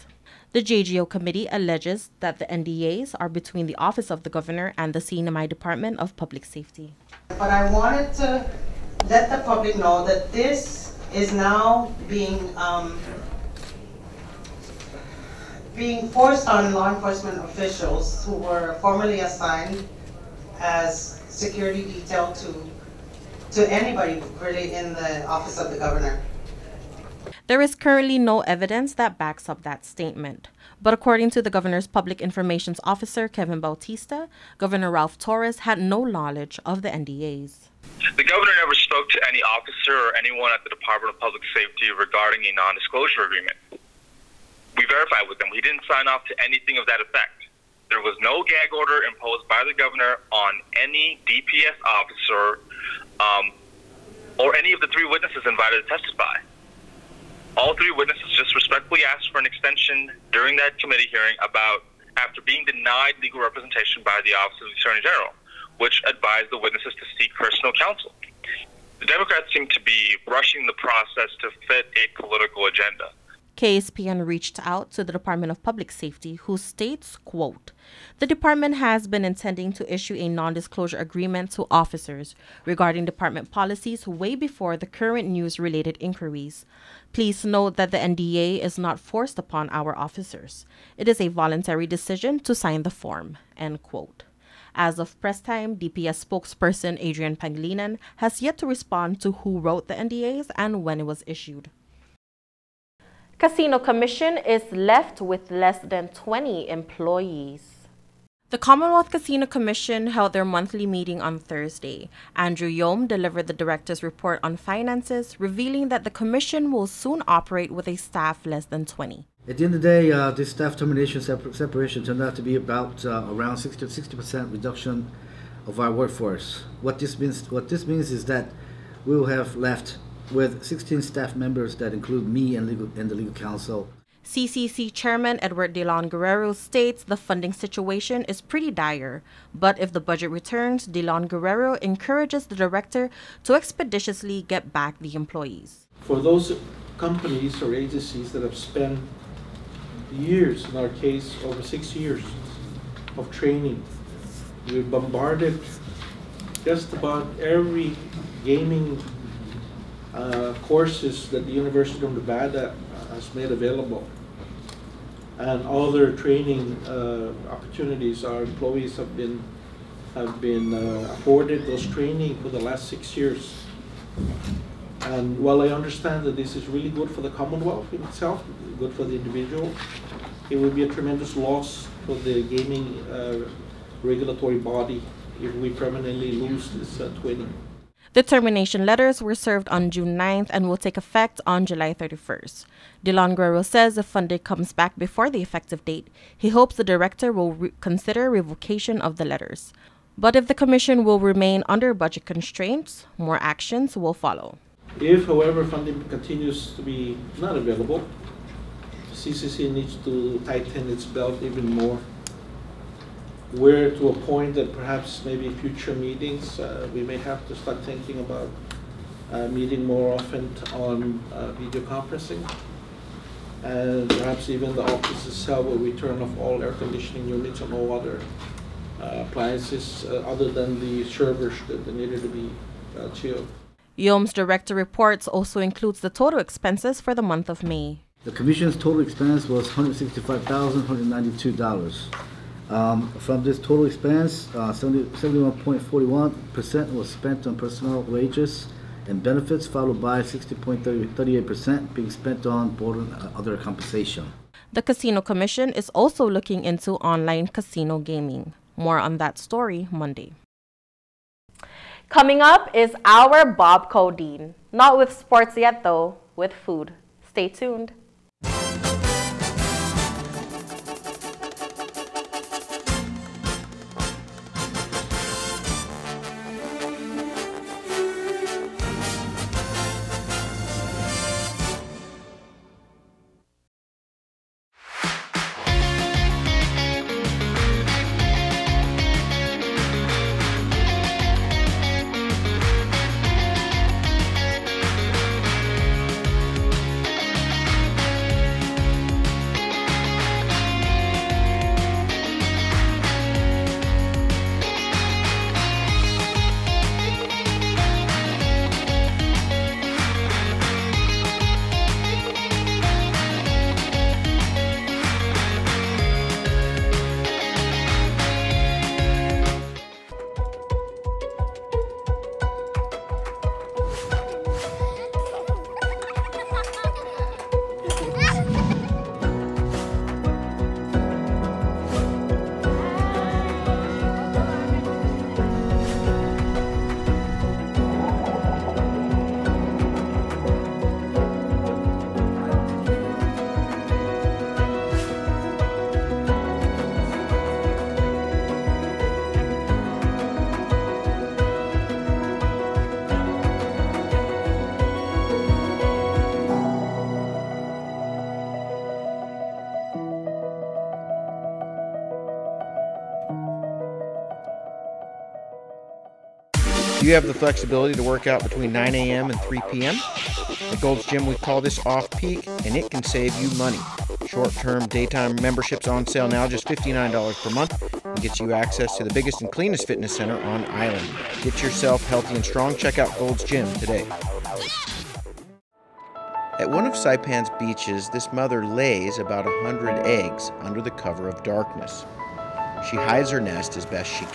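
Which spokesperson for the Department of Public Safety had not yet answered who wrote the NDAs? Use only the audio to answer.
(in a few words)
Adrian Pangilinan.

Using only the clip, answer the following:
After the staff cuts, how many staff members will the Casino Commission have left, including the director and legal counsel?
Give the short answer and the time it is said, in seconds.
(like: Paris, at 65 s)
16, at 130 s.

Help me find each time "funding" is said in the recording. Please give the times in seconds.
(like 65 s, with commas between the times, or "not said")
137 s, 194 s, 205 s.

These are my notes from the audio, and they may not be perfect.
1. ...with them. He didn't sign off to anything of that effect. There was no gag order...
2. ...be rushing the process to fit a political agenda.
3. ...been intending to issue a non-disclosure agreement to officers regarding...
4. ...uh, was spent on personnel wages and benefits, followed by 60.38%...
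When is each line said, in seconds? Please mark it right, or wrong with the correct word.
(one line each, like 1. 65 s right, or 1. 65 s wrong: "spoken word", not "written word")
1. 45 s right
2. 69 s right
3. 79 s right
4. 245 s right.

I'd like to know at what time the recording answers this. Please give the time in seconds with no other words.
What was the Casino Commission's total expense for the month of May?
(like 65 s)
239 s.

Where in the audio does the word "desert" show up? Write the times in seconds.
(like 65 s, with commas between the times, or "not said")
not said.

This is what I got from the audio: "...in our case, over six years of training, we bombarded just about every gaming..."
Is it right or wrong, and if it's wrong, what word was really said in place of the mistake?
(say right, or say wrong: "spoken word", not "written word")
right.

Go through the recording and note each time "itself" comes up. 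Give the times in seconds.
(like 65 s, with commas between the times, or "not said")
178 s, 225 s.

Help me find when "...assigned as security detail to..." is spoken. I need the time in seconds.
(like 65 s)
19 s.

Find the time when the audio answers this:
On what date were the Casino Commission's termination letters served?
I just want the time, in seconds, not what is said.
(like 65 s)
189 s.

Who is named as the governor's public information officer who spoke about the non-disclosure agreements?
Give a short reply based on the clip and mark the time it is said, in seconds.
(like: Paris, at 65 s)
Kevin Bautista, at 33 s.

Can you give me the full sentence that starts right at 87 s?
Please note that the NDA is not forced upon our officers.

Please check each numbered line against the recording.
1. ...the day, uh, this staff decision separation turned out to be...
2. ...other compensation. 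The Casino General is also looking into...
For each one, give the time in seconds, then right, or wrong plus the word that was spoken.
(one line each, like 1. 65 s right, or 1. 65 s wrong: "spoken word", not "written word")
1. 119 s wrong: "termination", not "decision"
2. 253 s wrong: "Commission", not "General".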